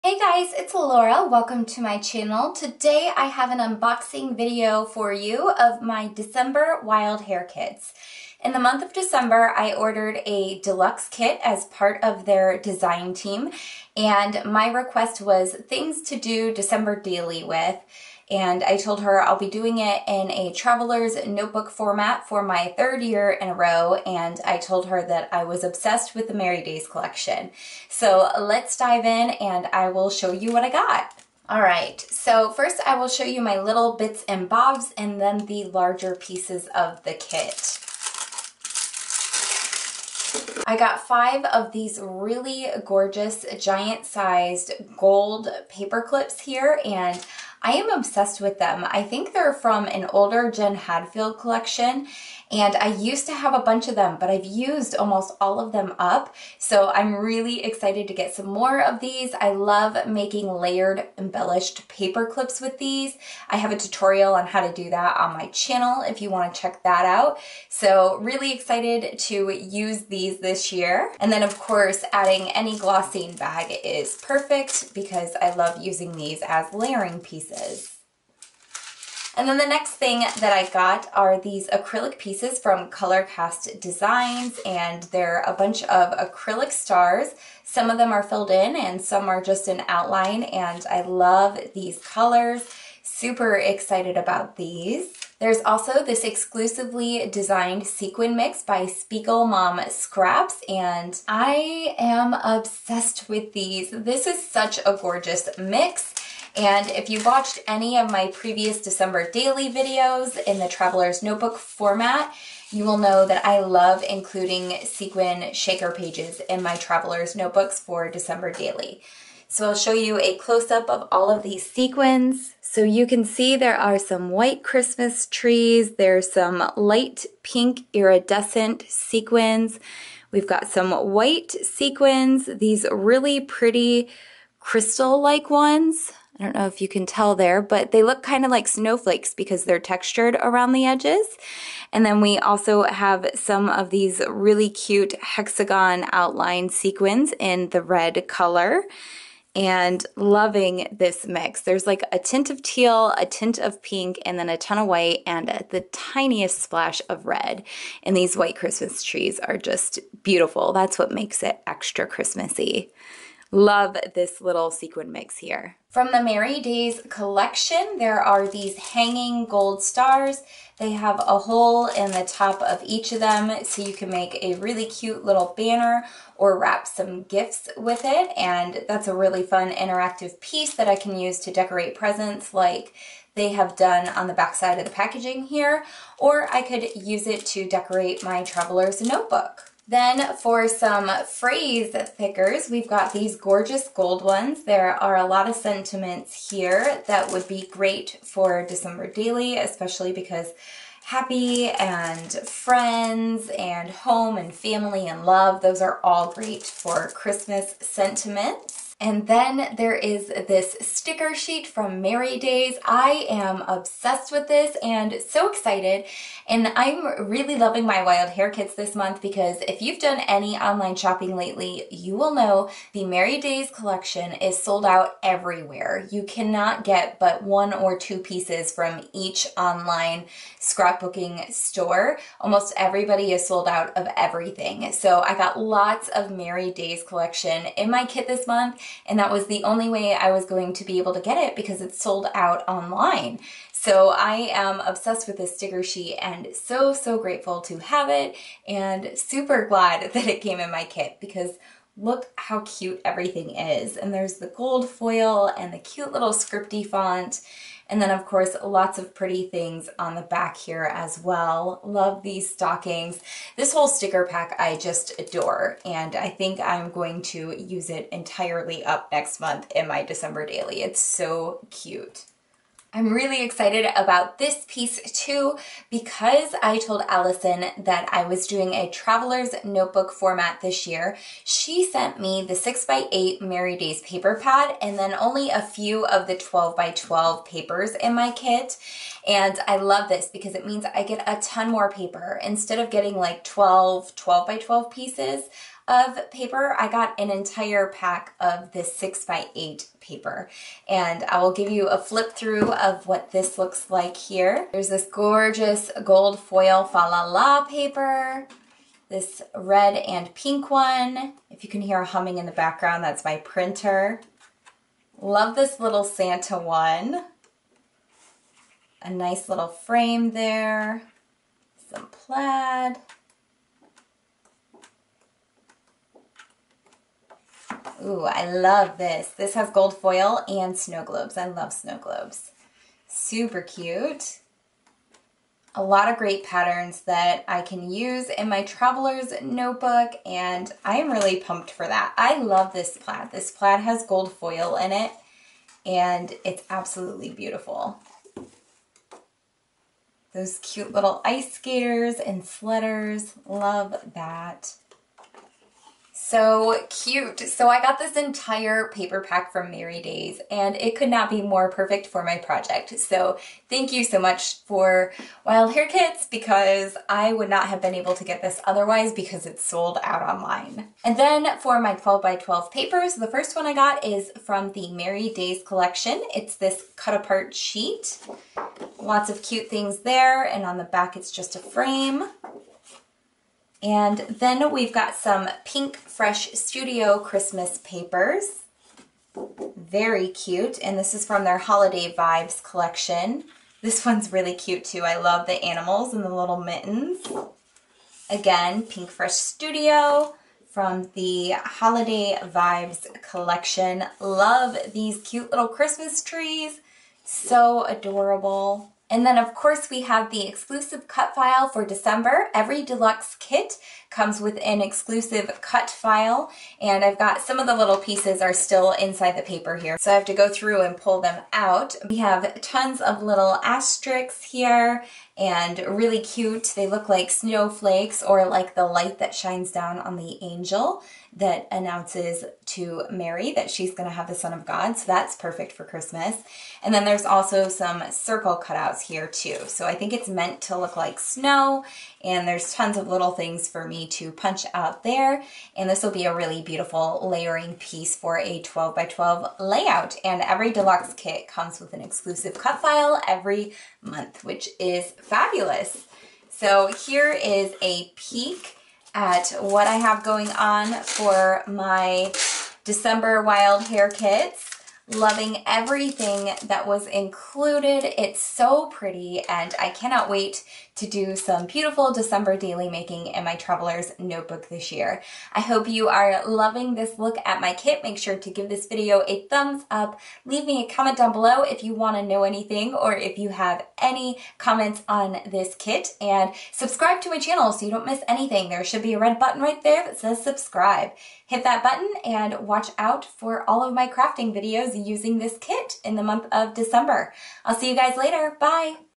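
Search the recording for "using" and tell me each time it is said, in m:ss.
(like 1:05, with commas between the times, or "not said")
1:15, 8:15.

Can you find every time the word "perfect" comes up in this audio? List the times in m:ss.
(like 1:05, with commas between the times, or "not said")
1:14, 6:01, 7:15.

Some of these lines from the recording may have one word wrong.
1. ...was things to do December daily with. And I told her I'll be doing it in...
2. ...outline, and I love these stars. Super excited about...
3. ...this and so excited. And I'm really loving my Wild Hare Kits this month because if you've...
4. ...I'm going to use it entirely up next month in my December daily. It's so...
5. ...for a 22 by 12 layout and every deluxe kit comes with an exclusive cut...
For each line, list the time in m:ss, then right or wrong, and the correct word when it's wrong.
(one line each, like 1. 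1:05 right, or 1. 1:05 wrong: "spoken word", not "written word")
1. 0:15 right
2. 1:29 wrong: "colors", not "stars"
3. 3:34 right
4. 4:26 right
5. 7:28 wrong: "12", not "22".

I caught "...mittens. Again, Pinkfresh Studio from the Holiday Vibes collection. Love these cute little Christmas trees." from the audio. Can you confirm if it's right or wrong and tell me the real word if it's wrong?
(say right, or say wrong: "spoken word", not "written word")
right.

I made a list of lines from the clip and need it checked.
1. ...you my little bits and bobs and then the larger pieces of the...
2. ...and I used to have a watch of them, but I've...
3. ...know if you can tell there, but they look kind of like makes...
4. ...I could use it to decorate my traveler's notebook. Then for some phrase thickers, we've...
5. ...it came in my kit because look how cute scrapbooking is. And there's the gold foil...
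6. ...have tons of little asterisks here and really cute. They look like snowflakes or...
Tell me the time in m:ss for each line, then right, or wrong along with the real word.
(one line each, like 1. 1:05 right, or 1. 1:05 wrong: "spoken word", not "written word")
1. 0:33 right
2. 0:52 wrong: "bunch", not "watch"
3. 2:16 wrong: "snowflakes", not "makes"
4. 3:06 right
5. 4:10 wrong: "everything", not "scrapbooking"
6. 7:02 right.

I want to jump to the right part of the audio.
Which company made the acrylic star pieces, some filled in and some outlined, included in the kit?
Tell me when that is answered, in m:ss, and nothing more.
1:22.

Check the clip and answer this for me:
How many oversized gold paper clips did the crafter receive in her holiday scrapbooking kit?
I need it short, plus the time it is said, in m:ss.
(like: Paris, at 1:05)
5, at 0:41.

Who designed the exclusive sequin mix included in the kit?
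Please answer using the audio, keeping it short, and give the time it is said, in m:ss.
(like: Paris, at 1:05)
Spiegel Mom Scraps, at 1:38.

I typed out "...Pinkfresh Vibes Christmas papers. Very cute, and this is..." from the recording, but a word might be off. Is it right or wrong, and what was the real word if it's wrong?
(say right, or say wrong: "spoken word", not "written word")
wrong: "Studio", not "Vibes".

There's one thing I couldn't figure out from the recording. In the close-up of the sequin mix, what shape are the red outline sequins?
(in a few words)
Hexagon.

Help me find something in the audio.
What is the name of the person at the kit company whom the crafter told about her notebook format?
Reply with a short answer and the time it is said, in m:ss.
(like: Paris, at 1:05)
Allison, at 4:37.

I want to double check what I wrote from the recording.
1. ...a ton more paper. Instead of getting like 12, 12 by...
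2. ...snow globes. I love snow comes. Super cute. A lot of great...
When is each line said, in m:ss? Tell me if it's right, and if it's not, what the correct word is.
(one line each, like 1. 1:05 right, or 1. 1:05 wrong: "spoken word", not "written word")
1. 4:51 right
2. 5:30 wrong: "globes", not "comes".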